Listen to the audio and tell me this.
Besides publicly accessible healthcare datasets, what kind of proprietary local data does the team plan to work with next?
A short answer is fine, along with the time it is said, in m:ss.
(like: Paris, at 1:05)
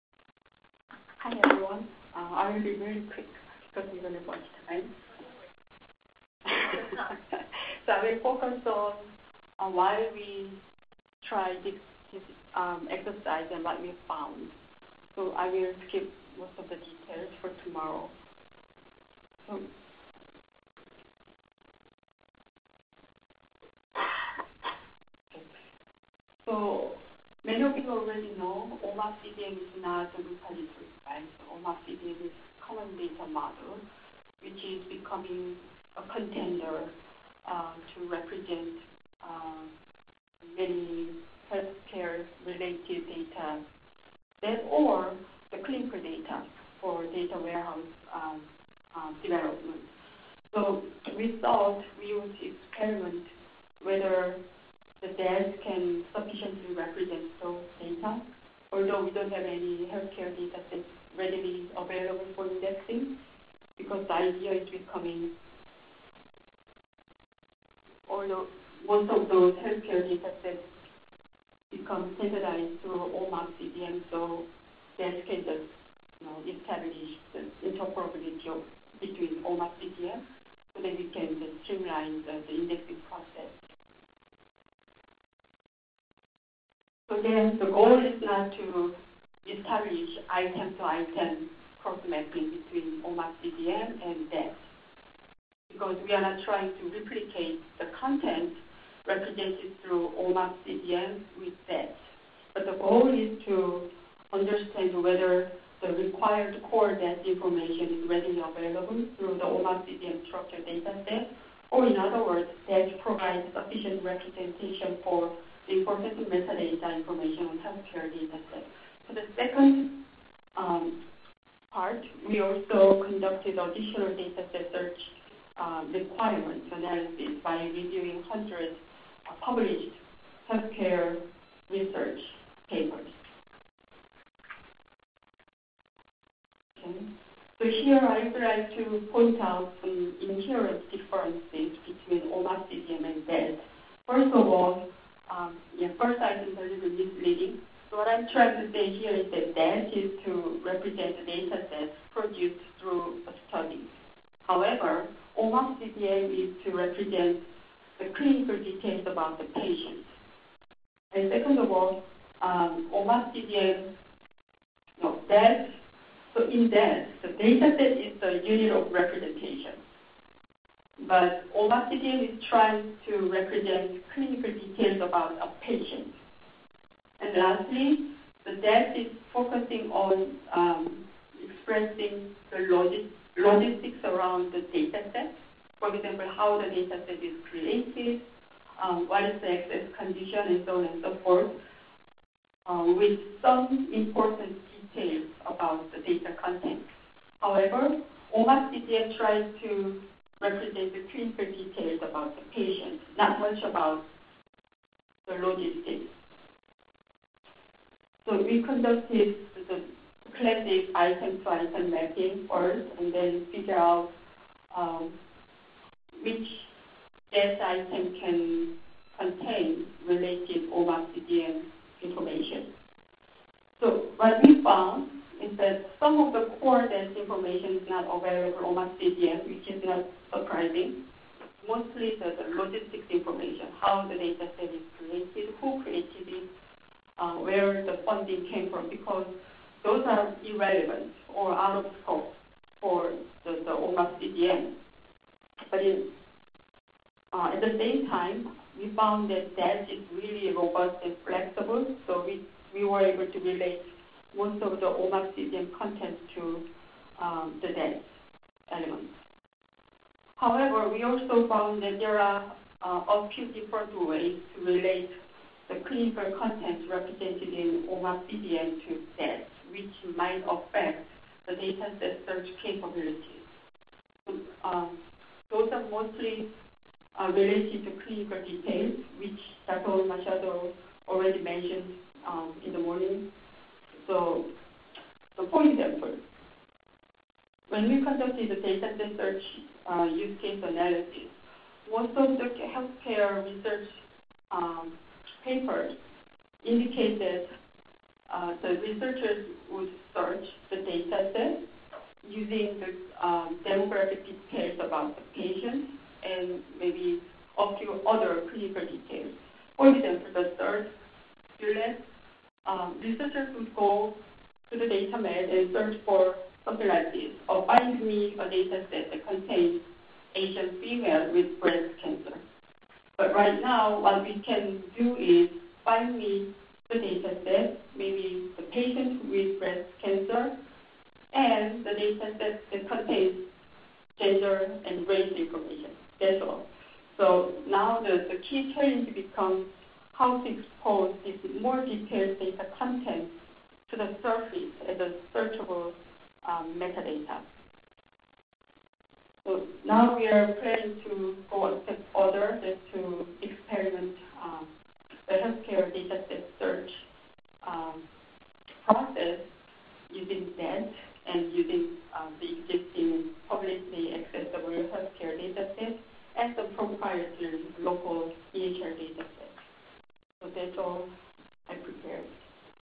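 EHR dataset, at 6:08.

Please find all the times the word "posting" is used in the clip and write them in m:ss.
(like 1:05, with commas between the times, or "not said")
not said.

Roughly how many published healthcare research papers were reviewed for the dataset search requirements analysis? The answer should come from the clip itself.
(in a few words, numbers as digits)
Hundreds.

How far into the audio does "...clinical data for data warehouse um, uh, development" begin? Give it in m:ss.
0:45.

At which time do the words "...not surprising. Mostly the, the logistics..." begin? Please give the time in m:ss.
3:49.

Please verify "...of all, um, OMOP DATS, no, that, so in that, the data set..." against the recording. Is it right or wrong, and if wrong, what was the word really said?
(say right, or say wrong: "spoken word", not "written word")
wrong: "CDM", not "DATS".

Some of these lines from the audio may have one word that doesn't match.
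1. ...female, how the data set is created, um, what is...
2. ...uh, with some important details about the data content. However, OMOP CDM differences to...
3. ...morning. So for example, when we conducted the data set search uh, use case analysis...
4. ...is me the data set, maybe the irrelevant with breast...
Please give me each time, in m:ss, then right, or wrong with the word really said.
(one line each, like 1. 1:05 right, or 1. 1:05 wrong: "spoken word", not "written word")
1. 3:05 wrong: "example", not "female"
2. 3:12 wrong: "tries", not "differences"
3. 4:42 right
4. 5:25 wrong: "patient", not "irrelevant".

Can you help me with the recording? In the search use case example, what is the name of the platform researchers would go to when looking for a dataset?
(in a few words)
DataMed.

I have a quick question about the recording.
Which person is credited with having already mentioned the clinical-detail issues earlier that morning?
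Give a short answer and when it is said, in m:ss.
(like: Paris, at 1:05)
Dr. Machado, at 4:39.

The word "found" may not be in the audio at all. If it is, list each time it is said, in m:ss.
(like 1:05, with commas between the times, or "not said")
0:14, 3:44, 4:08, 4:21.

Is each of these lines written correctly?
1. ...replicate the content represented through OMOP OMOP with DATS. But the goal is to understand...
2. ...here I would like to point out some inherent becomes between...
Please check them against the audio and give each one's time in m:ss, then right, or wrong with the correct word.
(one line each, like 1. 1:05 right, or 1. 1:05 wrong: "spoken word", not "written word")
1. 1:36 wrong: "CDM", not "OMOP"
2. 2:17 wrong: "differences", not "becomes".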